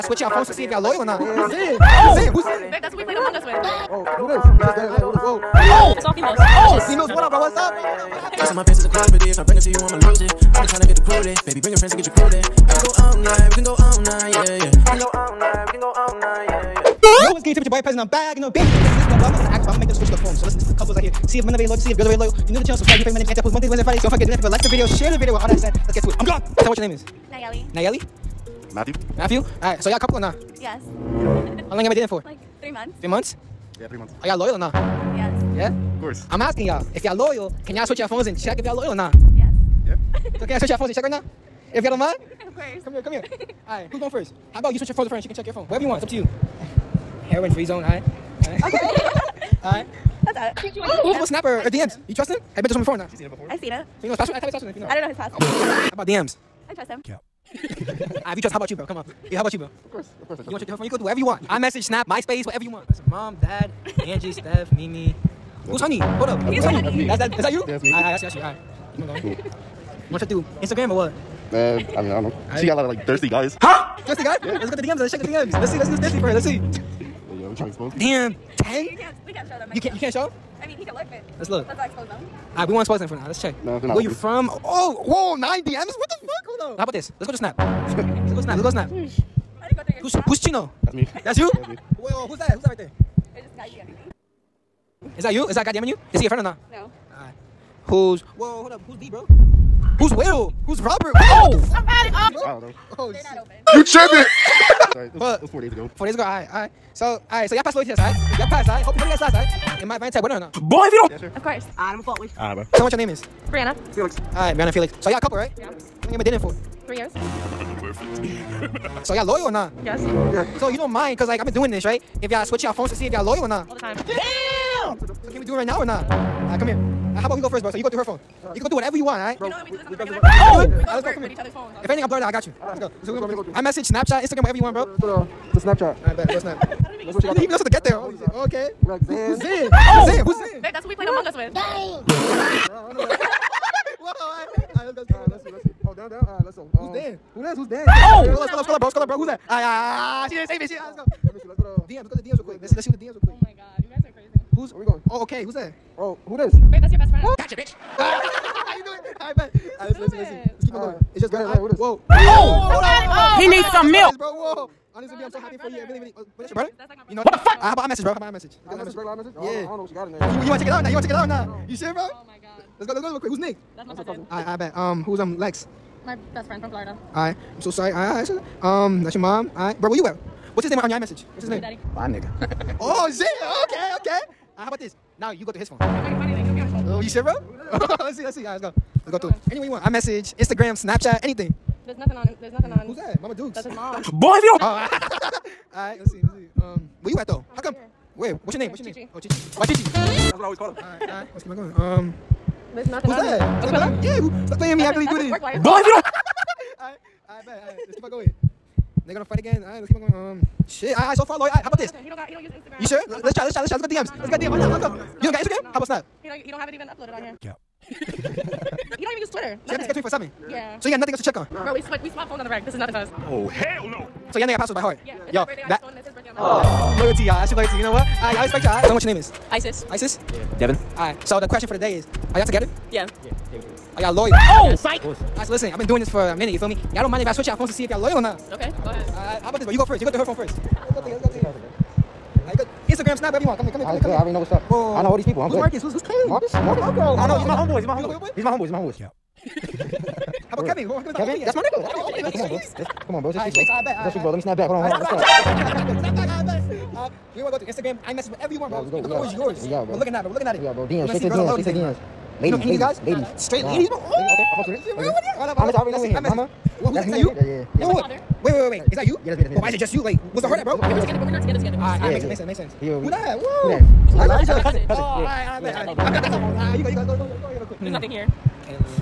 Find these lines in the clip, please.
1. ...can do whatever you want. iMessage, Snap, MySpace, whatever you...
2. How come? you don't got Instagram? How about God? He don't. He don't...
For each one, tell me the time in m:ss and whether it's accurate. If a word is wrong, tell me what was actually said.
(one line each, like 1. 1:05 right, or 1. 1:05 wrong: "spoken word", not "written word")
1. 1:00 right
2. 3:34 wrong: "Snap", not "God".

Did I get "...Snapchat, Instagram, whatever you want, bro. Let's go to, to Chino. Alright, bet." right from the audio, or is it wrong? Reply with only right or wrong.
wrong.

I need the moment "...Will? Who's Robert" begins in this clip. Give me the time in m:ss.
1:40.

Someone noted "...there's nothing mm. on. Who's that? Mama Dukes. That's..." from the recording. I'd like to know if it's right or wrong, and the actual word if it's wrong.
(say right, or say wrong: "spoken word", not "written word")
right.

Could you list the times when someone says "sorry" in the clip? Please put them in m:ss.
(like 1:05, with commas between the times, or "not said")
1:44, 2:57.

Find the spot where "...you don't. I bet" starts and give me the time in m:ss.
3:25.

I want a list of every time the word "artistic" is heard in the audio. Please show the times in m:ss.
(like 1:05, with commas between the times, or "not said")
not said.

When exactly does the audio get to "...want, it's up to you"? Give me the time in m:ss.
0:45.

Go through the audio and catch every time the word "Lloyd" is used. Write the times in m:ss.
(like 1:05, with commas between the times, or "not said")
3:31.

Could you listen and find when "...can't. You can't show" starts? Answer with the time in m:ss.
1:19.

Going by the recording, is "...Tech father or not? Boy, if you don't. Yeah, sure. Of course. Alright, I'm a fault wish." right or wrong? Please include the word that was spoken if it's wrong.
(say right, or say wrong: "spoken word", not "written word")
wrong: "winner", not "father".